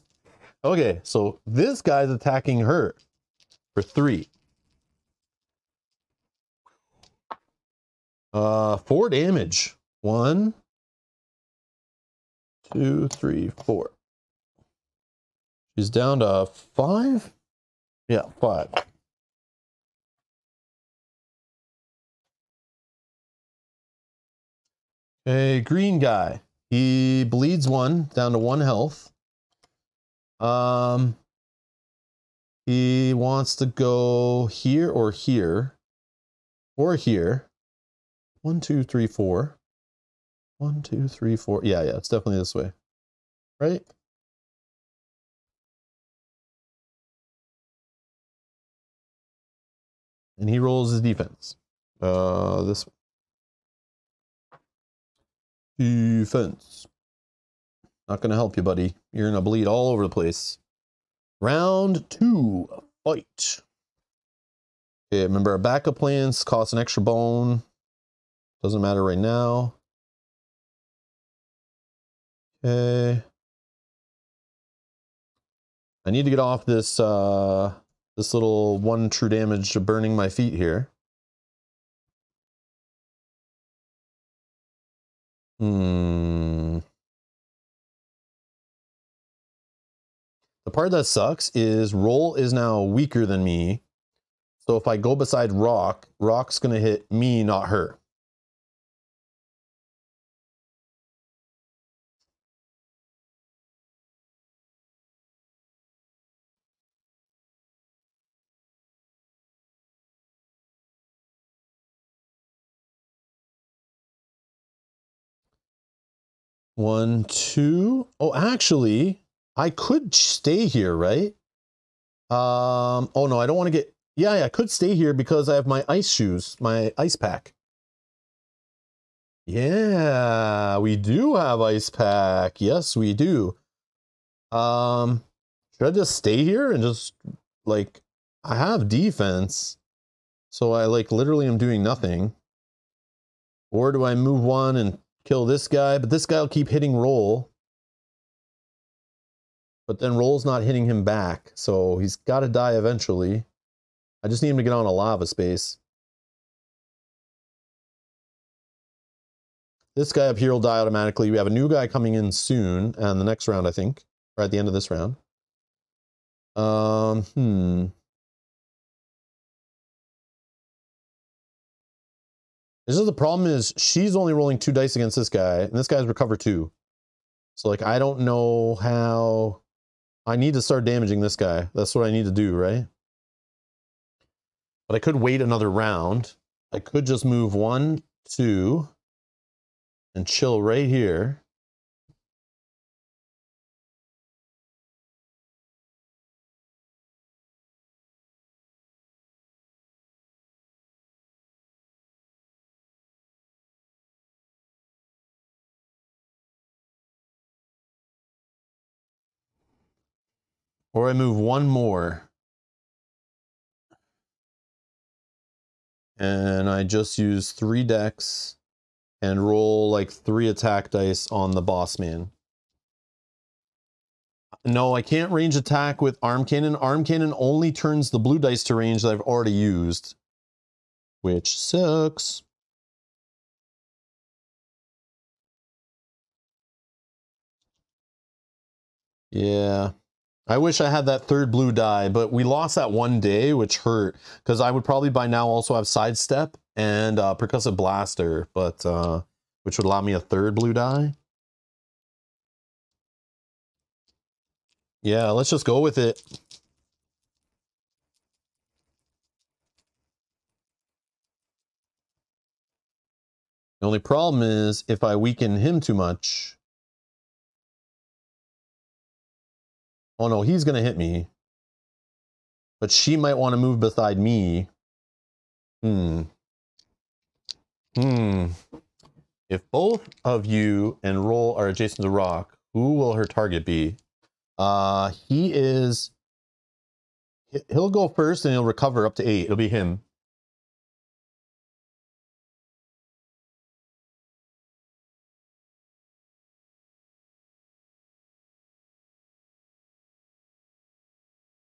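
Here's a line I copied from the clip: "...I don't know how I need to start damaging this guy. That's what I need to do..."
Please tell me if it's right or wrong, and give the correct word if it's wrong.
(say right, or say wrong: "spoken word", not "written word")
right.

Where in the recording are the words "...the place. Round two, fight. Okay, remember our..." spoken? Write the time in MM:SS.
01:00.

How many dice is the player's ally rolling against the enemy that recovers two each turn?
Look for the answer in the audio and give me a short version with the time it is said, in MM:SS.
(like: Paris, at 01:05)
2, at 02:54.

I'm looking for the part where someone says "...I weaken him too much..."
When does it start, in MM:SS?
04:25.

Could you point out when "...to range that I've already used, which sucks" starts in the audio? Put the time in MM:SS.
03:48.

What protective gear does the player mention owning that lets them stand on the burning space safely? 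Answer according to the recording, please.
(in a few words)
ice shoes.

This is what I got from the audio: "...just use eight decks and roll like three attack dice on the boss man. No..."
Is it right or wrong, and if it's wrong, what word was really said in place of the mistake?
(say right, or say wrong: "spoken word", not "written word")
wrong: "three", not "eight".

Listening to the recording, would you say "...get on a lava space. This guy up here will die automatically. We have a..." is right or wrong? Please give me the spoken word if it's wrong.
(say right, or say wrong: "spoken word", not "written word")
right.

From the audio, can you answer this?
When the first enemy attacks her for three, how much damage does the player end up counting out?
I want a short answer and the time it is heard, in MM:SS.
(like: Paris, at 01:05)
4, at 00:08.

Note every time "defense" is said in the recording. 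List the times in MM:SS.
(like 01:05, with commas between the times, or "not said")
00:51, 00:55, 02:18.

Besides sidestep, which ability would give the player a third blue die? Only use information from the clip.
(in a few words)
percussive blaster.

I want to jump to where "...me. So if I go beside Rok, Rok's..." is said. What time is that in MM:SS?
01:33.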